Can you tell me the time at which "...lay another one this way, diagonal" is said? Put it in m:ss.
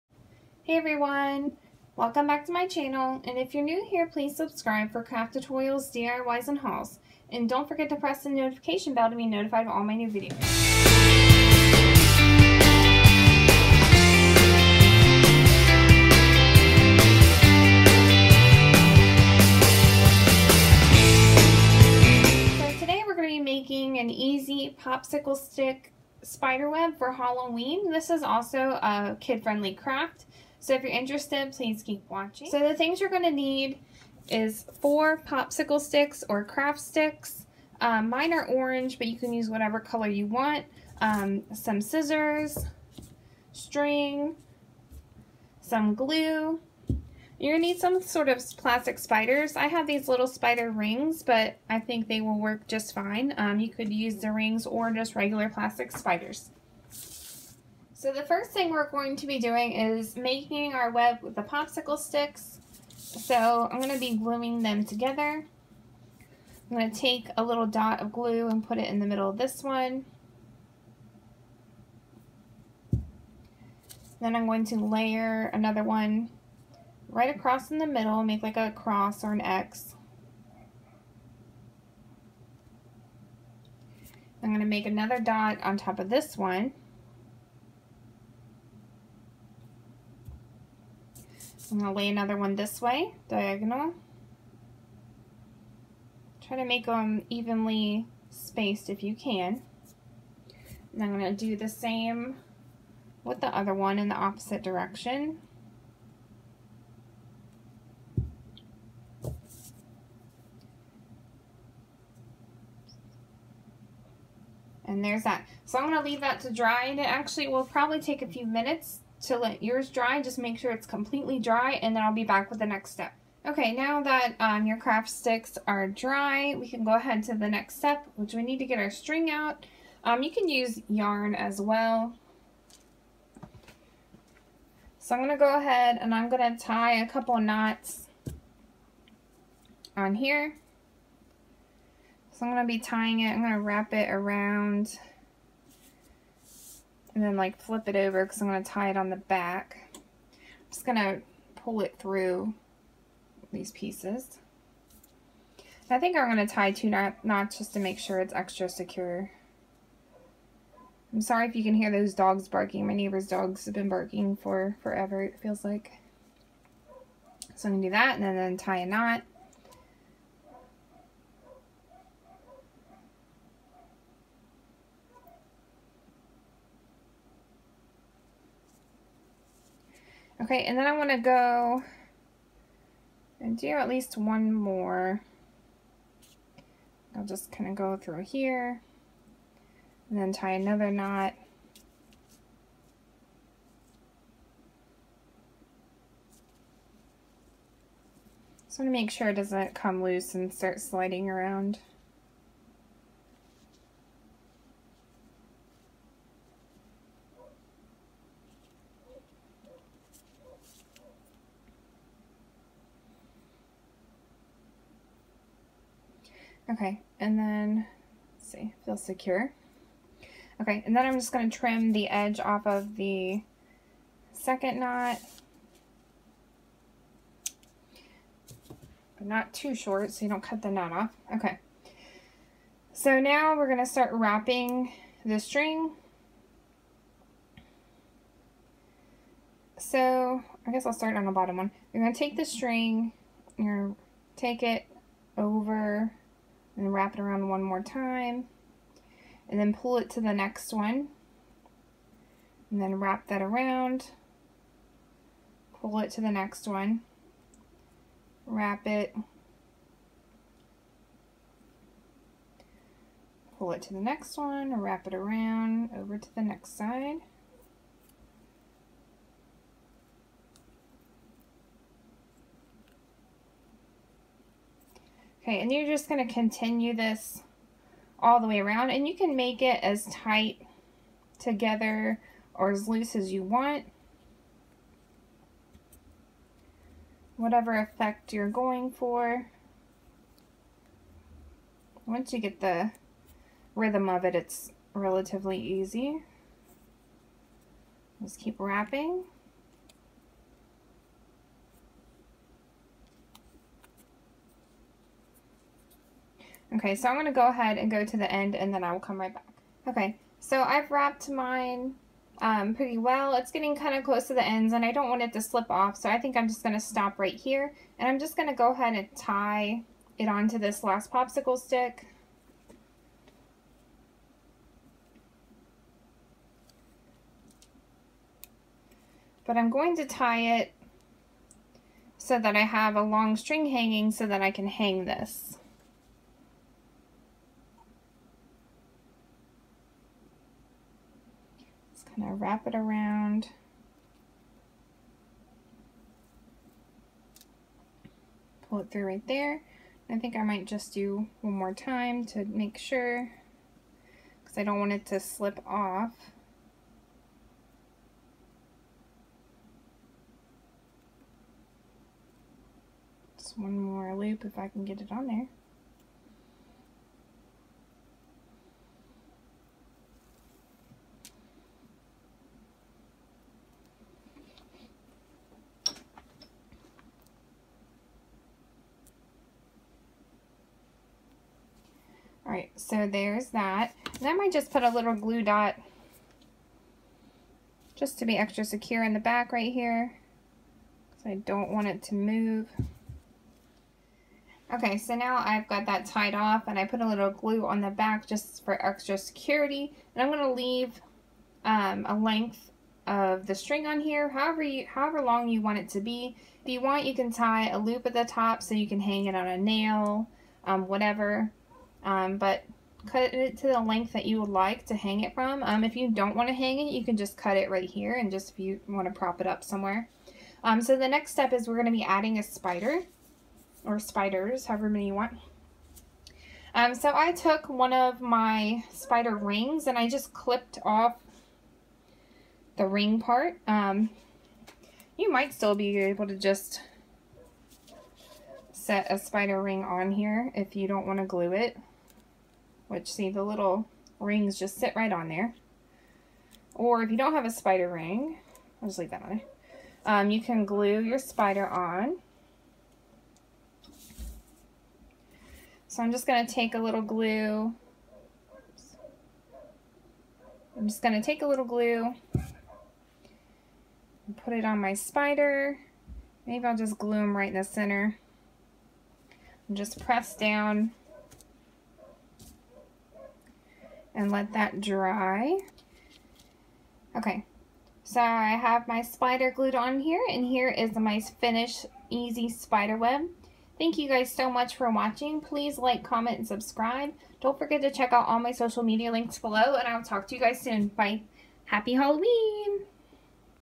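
1:31.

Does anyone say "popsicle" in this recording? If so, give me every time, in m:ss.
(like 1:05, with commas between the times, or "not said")
0:24, 0:35, 1:01, 5:21.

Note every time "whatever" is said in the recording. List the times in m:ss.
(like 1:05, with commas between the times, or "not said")
0:39, 4:47, 6:50.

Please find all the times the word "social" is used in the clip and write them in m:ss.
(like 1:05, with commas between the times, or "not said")
8:08.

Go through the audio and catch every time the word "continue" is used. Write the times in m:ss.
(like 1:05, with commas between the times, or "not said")
4:36.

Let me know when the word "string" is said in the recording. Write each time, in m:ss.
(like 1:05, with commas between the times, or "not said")
0:43, 2:08, 3:55, 4:02, 5:33, 6:43.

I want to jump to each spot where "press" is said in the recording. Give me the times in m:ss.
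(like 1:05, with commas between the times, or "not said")
0:07, 7:50.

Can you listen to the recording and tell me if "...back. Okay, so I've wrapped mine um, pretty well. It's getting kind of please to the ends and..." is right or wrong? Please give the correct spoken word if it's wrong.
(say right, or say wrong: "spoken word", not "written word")
wrong: "close", not "please".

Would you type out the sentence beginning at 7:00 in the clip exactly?
Um, so the next step is we're going to be adding a spider or spiders, however many you want.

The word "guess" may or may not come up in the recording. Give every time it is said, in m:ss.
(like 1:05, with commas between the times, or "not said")
4:00.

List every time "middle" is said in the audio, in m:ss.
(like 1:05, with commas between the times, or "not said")
1:09, 1:17.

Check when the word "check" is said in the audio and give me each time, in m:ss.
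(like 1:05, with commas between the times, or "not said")
8:07.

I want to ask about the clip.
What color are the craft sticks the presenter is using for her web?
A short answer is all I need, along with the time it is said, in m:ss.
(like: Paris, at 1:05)
Orange, at 0:38.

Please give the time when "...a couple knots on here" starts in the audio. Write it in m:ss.
2:17.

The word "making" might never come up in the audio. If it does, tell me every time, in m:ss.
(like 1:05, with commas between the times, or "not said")
0:23, 1:00.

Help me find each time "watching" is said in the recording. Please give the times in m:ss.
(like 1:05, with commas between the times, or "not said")
0:32, 8:04.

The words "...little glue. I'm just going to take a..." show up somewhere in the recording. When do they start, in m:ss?
7:36.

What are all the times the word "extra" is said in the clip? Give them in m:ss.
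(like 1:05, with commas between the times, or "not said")
2:38, 6:28, 6:38.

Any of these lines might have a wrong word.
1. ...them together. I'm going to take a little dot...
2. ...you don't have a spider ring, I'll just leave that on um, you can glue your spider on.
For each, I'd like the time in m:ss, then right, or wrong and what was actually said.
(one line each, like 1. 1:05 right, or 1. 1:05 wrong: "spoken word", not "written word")
1. 1:04 right
2. 7:27 right.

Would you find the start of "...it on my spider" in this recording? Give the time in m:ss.
7:44.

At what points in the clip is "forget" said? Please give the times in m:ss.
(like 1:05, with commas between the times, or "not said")
0:07, 8:07.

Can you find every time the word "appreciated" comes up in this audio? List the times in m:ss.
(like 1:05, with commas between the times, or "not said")
not said.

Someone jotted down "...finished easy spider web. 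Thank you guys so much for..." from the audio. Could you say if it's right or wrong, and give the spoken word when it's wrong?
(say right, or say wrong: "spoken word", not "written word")
right.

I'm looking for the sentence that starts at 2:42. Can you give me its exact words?
My neighbor's dogs have been barking for forever, it feels like.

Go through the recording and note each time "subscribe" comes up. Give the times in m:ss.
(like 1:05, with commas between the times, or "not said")
0:04, 8:06.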